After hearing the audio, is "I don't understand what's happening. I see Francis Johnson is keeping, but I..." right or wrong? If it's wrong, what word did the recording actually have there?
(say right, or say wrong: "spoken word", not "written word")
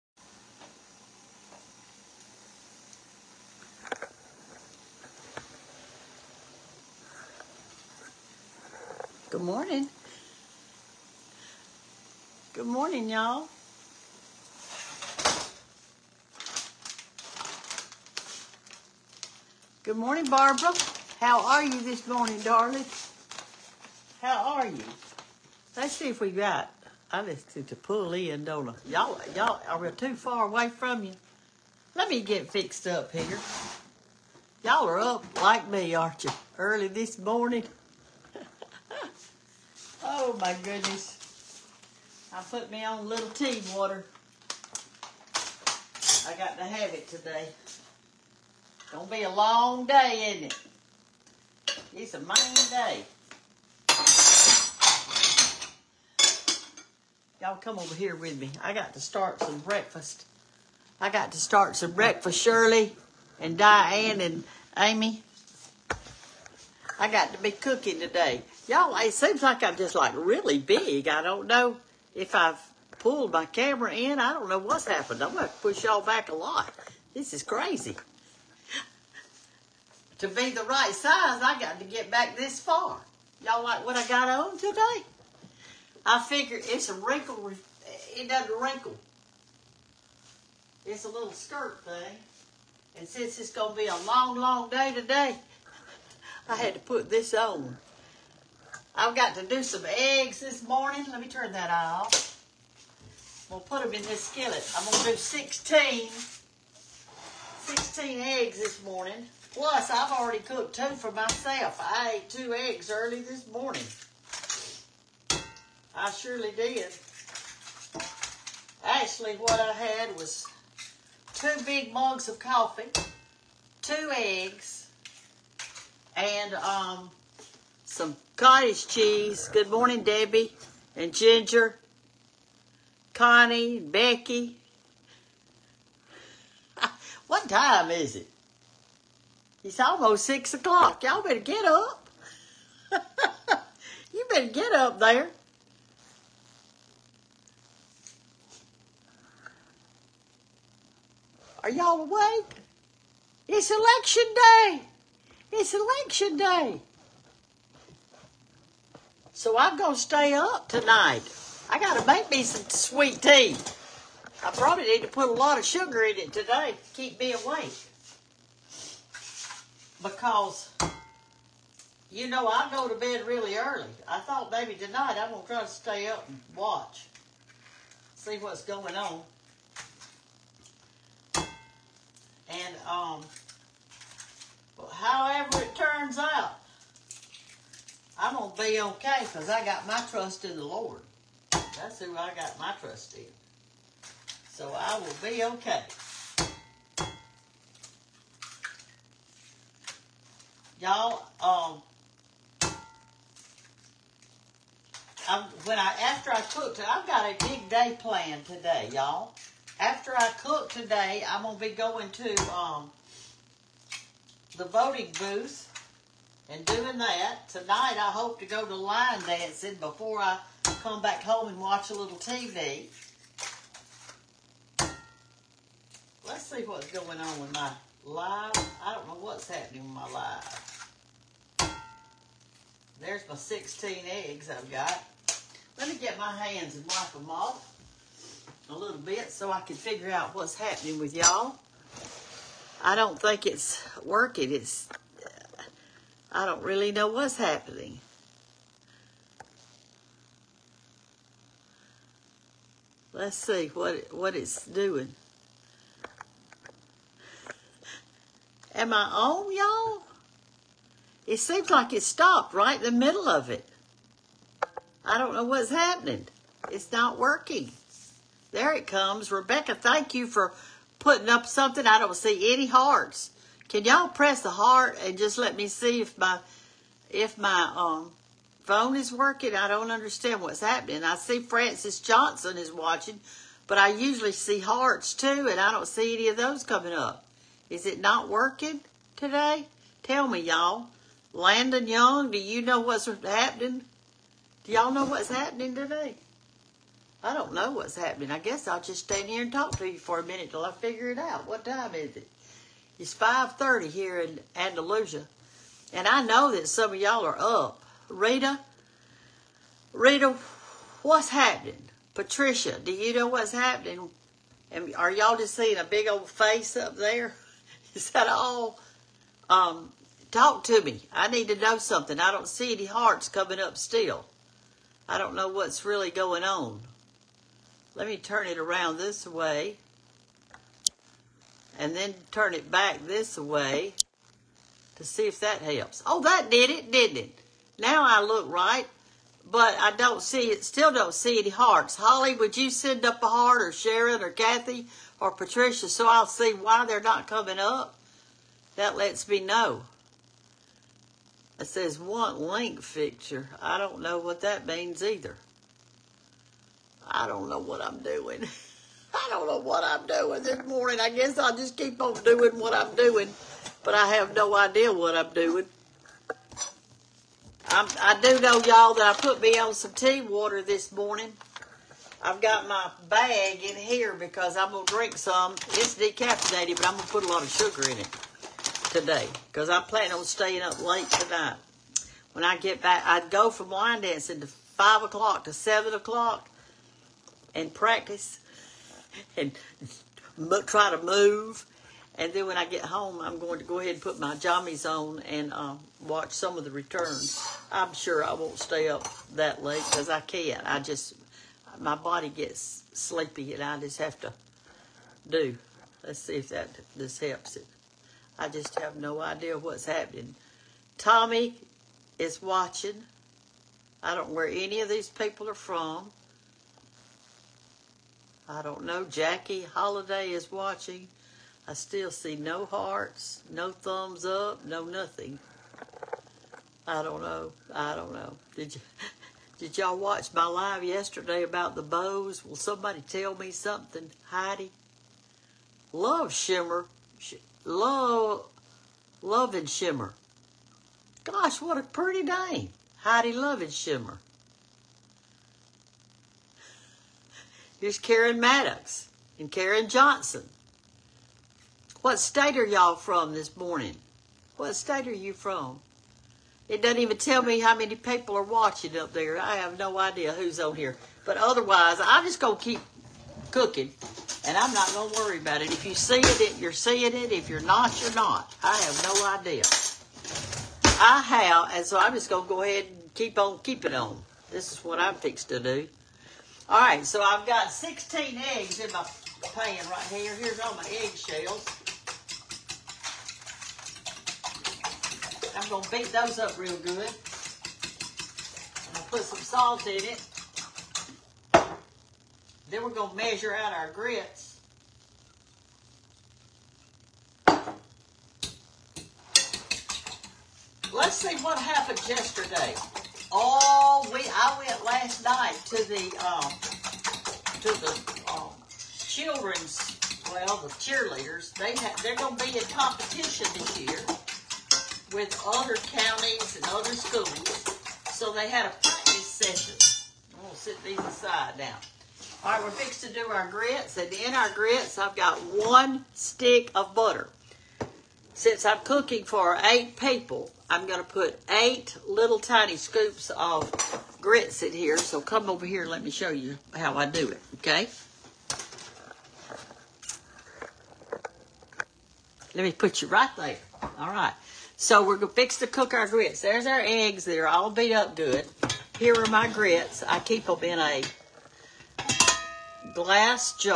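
wrong: "watching", not "keeping".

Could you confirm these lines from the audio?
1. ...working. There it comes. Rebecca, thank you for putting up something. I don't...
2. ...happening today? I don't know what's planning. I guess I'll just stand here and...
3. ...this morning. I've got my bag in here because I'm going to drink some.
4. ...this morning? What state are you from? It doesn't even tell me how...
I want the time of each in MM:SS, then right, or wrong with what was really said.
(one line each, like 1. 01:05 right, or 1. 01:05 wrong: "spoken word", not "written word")
1. 04:27 right
2. 04:55 wrong: "happening", not "planning"
3. 06:10 right
4. 07:33 right.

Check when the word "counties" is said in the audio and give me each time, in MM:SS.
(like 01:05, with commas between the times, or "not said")
08:35.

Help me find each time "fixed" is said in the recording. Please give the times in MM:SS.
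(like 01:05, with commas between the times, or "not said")
00:32, 07:55, 08:42.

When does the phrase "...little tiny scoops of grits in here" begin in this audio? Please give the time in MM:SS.
08:52.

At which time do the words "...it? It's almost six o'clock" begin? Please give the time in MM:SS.
02:18.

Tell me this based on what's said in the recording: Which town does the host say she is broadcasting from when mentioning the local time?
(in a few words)
Andalusia.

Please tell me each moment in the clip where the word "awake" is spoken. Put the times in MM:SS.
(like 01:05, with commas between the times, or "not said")
02:32, 02:47.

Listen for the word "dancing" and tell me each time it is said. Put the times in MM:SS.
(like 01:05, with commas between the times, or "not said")
03:39, 06:24.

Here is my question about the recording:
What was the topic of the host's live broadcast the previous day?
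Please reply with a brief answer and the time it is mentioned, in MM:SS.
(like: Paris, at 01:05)
bows, at 07:11.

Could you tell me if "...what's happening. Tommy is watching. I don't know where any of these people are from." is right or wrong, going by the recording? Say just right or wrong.
right.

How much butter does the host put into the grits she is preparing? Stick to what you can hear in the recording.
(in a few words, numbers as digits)
1 stick.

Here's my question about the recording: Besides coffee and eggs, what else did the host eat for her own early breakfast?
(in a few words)
cottage cheese.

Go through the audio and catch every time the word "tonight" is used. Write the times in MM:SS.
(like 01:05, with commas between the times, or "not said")
02:40, 02:54, 03:37, 06:21.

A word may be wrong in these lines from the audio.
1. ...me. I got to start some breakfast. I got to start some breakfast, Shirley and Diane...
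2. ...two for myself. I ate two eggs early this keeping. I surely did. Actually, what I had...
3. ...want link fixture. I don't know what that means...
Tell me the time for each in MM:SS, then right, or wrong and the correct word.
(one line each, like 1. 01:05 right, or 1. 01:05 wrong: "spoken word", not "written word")
1. 00:58 right
2. 01:50 wrong: "morning", not "keeping"
3. 05:51 right.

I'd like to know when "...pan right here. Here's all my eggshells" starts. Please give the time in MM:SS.
07:59.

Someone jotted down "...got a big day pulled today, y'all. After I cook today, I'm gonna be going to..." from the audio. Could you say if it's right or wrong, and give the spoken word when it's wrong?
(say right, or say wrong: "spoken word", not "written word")
wrong: "planned", not "pulled".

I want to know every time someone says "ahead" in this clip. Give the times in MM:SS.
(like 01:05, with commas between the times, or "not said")
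06:33, 07:52.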